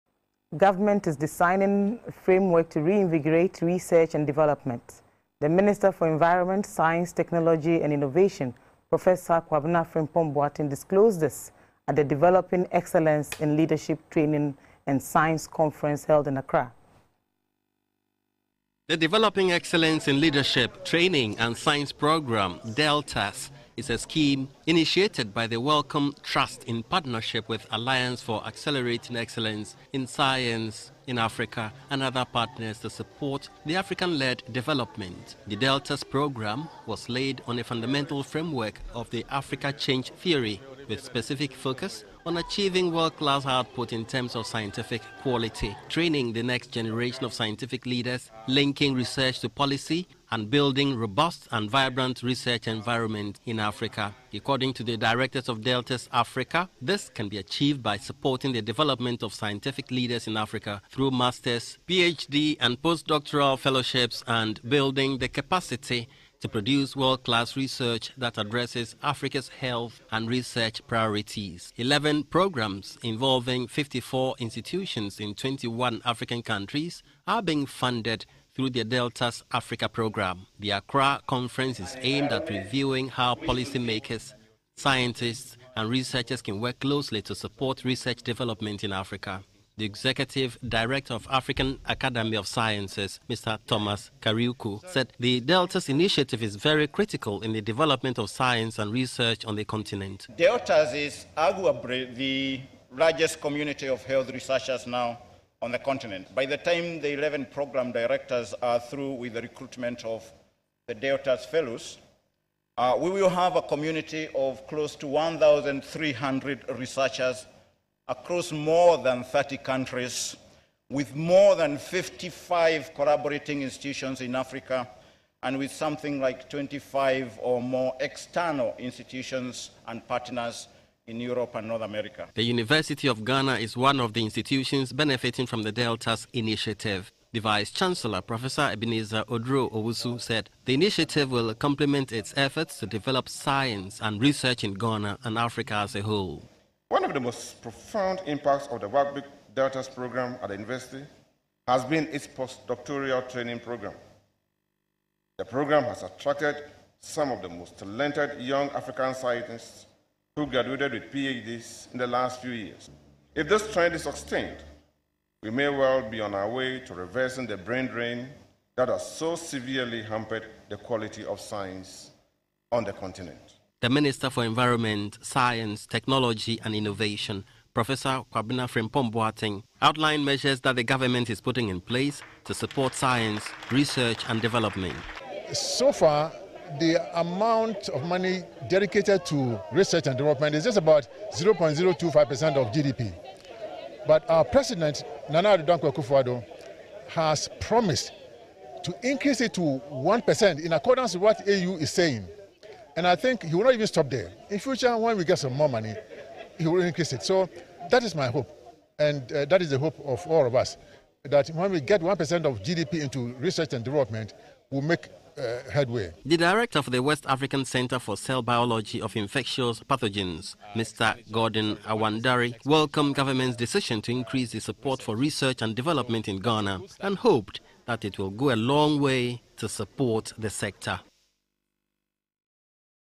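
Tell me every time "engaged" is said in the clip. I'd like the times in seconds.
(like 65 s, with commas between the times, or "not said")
not said.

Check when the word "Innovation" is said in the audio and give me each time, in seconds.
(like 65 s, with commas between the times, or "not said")
7 s, 176 s.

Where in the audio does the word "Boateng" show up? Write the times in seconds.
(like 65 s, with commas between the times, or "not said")
10 s, 179 s.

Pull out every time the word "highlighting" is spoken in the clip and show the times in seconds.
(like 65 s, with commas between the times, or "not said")
not said.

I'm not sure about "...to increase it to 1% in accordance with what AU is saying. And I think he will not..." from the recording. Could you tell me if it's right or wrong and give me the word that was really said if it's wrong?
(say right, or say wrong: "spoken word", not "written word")
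right.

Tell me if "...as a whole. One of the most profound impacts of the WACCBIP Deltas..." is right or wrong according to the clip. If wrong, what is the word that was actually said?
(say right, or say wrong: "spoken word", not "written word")
right.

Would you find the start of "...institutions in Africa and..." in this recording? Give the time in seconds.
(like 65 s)
123 s.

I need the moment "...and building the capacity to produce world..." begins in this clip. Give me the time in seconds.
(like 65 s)
64 s.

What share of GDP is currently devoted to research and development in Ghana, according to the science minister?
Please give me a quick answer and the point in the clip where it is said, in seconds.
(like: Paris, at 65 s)
0.025%, at 191 s.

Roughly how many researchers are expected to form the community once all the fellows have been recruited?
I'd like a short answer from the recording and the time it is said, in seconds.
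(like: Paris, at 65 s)
1,300, at 115 s.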